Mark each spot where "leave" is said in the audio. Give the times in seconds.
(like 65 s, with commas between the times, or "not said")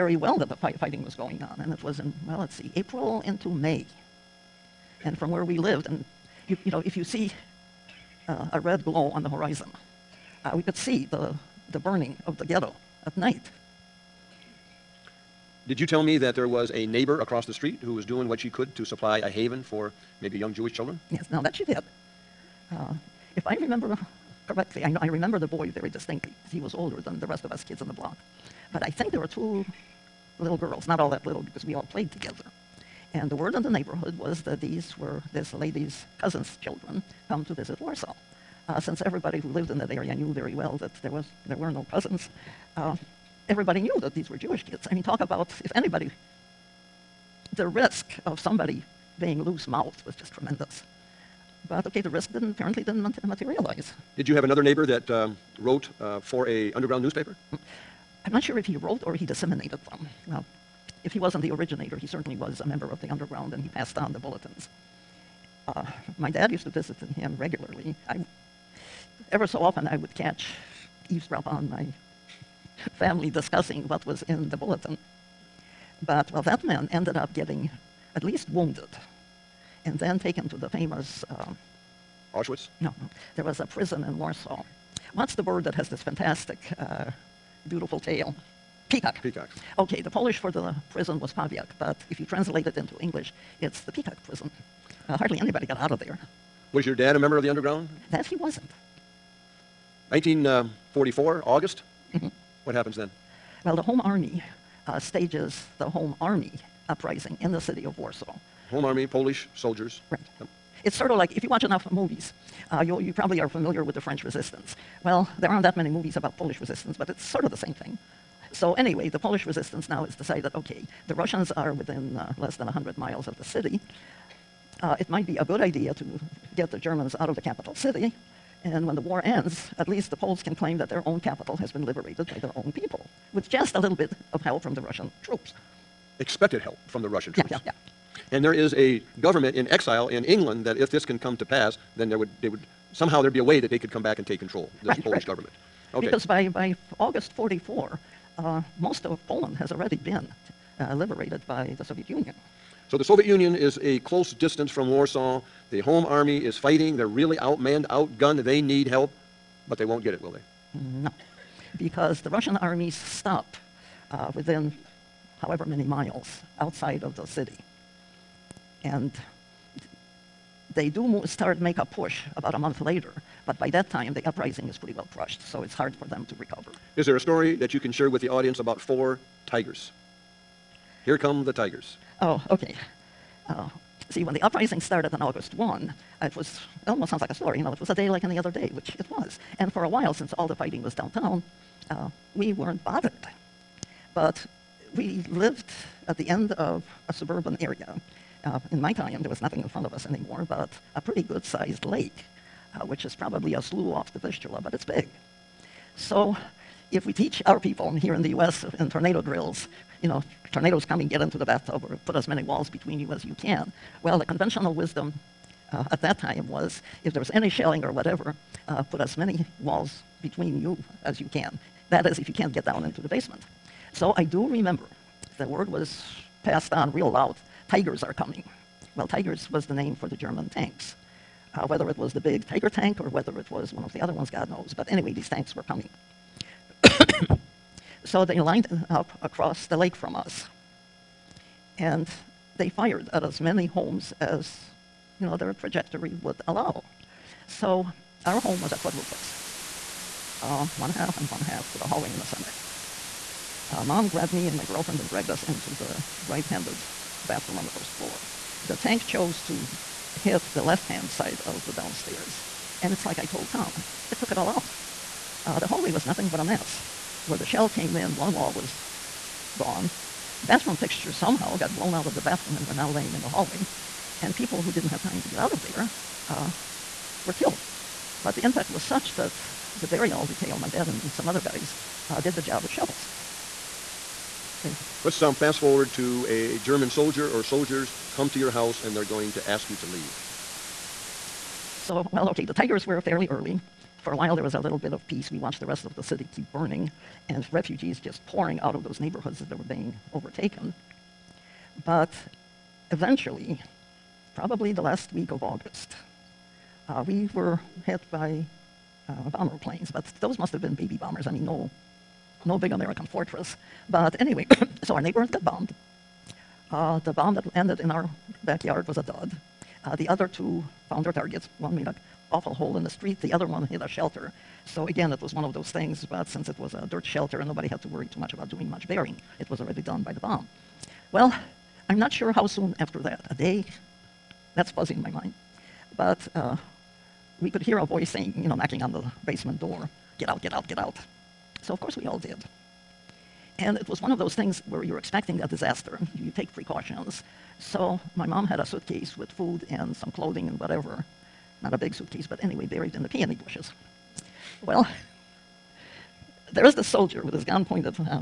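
289 s.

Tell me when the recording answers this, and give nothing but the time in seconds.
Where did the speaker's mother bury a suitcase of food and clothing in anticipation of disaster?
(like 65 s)
353 s.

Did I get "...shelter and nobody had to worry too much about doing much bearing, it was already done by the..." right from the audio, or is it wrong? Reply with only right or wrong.
right.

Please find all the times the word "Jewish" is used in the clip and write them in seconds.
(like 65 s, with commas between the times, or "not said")
20 s, 44 s.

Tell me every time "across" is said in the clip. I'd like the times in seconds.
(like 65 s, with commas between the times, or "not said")
17 s, 239 s.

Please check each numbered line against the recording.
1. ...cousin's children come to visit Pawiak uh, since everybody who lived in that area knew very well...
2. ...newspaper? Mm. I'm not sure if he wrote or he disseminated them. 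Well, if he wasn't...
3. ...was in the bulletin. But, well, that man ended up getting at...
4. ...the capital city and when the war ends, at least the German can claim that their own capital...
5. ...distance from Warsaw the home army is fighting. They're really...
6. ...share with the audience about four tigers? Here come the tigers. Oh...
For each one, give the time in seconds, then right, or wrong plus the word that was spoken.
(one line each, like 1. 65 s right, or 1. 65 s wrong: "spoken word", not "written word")
1. 36 s wrong: "Warsaw", not "Pawiak"
2. 57 s right
3. 74 s right
4. 127 s wrong: "Poles", not "German"
5. 154 s right
6. 177 s right.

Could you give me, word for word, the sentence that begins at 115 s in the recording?
Well, there aren't that many movies about Polish resistance, but it's sort of the same thing.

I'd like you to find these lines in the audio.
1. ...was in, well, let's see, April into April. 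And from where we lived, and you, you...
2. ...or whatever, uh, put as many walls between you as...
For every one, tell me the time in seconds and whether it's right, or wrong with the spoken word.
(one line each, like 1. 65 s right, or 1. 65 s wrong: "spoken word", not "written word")
1. 1 s wrong: "May", not "April"
2. 217 s right.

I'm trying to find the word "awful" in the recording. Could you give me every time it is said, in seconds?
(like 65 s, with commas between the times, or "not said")
322 s.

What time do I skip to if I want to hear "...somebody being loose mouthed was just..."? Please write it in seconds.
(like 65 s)
48 s.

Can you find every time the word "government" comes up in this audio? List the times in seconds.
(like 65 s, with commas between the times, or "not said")
139 s, 145 s.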